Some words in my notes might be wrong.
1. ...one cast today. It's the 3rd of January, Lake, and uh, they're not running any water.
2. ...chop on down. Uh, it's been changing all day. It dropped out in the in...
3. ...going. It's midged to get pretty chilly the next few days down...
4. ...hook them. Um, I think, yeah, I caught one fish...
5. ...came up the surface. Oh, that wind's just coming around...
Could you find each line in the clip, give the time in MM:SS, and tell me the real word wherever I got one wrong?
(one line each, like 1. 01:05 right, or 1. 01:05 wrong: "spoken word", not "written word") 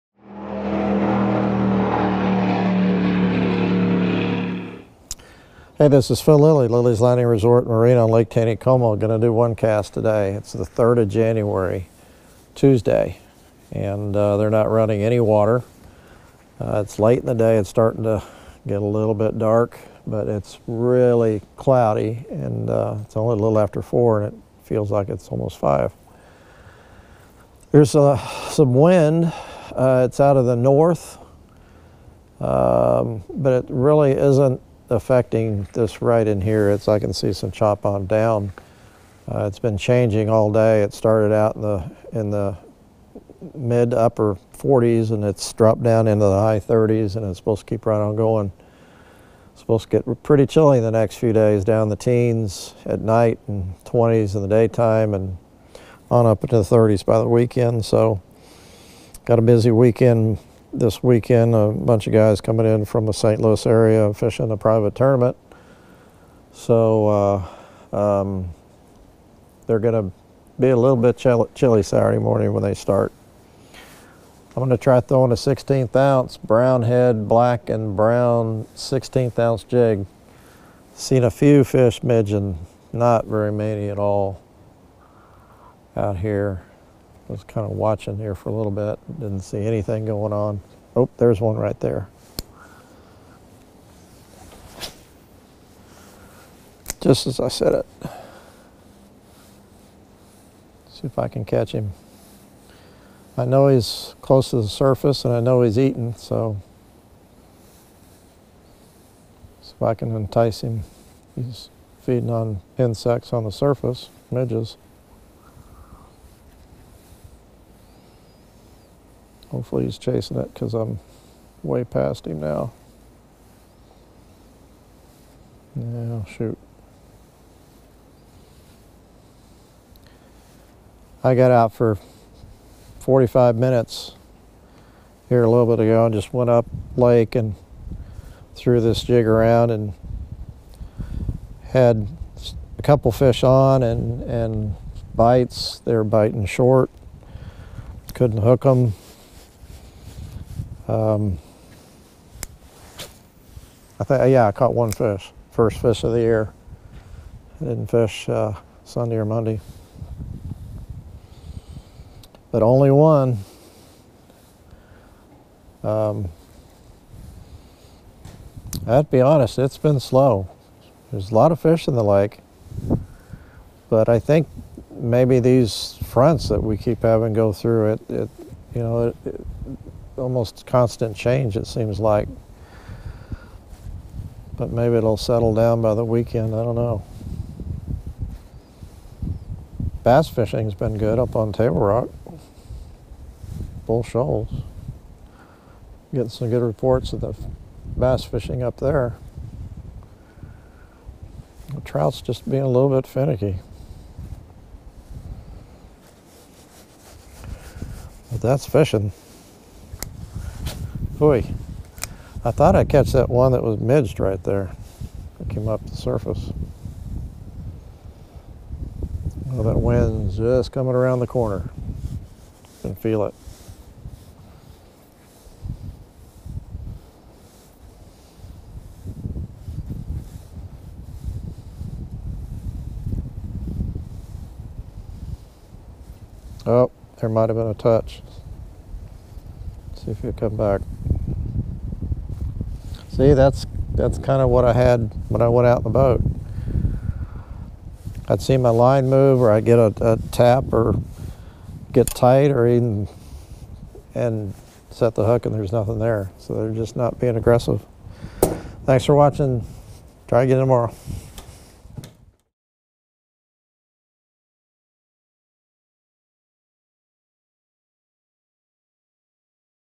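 1. 00:09 wrong: "Tuesday", not "Lake"
2. 00:37 wrong: "started", not "dropped"
3. 00:48 wrong: "supposed", not "midged"
4. 02:28 right
5. 03:35 right.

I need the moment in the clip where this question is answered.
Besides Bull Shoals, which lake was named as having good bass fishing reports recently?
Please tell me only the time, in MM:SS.
03:11.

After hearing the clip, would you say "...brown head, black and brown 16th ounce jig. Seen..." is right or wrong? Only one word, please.
right.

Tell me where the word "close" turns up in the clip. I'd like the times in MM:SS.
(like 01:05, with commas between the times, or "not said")
01:44.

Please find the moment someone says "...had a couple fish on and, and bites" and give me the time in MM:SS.
02:21.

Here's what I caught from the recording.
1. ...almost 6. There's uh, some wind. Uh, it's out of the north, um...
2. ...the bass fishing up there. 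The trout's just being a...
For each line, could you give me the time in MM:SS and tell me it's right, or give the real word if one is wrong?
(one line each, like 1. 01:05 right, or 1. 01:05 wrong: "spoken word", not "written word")
1. 00:25 wrong: "5", not "6"
2. 03:17 right.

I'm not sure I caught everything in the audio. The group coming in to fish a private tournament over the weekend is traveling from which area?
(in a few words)
St. Louis.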